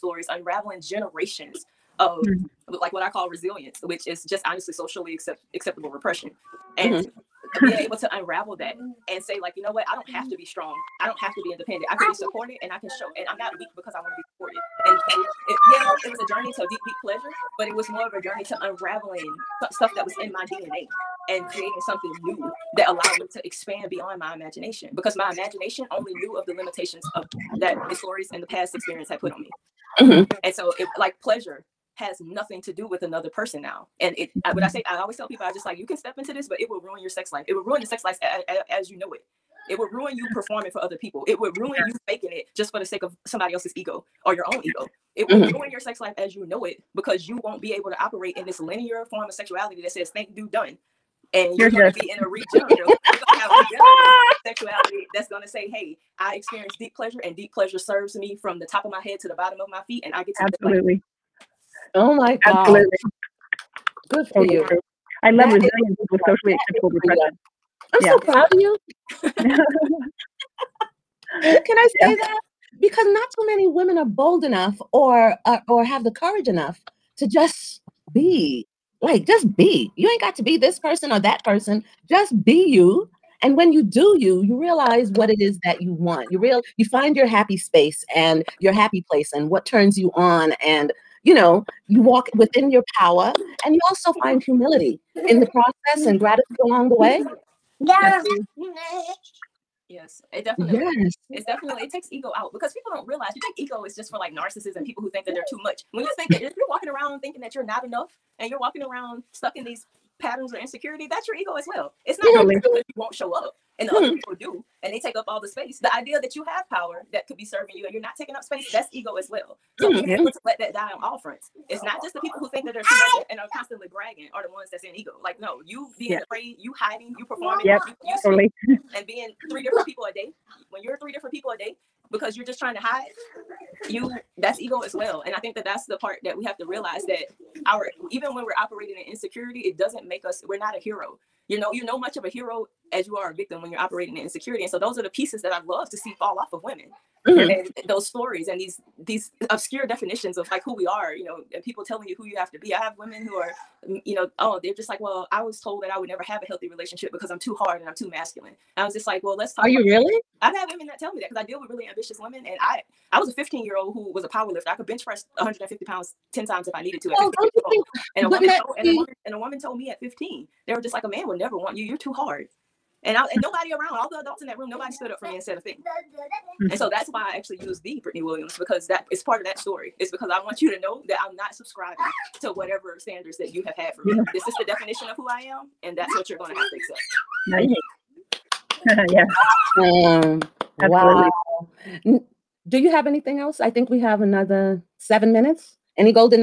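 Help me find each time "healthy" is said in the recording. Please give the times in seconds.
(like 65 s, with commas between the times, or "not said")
156 s.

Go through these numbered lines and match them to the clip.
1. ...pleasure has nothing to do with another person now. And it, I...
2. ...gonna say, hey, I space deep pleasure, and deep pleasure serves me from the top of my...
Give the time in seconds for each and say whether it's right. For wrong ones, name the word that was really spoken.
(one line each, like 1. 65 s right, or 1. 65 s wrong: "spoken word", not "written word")
1. 31 s right
2. 55 s wrong: "experience", not "space".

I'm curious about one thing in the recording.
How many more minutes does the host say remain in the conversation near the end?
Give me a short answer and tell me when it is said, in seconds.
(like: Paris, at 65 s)
7, at 194 s.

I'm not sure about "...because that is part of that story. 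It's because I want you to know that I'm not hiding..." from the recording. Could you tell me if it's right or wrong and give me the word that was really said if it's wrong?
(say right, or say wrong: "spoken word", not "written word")
wrong: "subscribing", not "hiding".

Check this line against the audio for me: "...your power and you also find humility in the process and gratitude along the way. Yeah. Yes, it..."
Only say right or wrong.
right.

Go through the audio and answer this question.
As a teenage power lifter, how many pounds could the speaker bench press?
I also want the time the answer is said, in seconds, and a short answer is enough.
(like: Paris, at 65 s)
150, at 165 s.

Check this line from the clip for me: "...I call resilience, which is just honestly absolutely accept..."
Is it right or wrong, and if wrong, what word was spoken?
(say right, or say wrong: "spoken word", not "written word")
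wrong: "socially", not "absolutely".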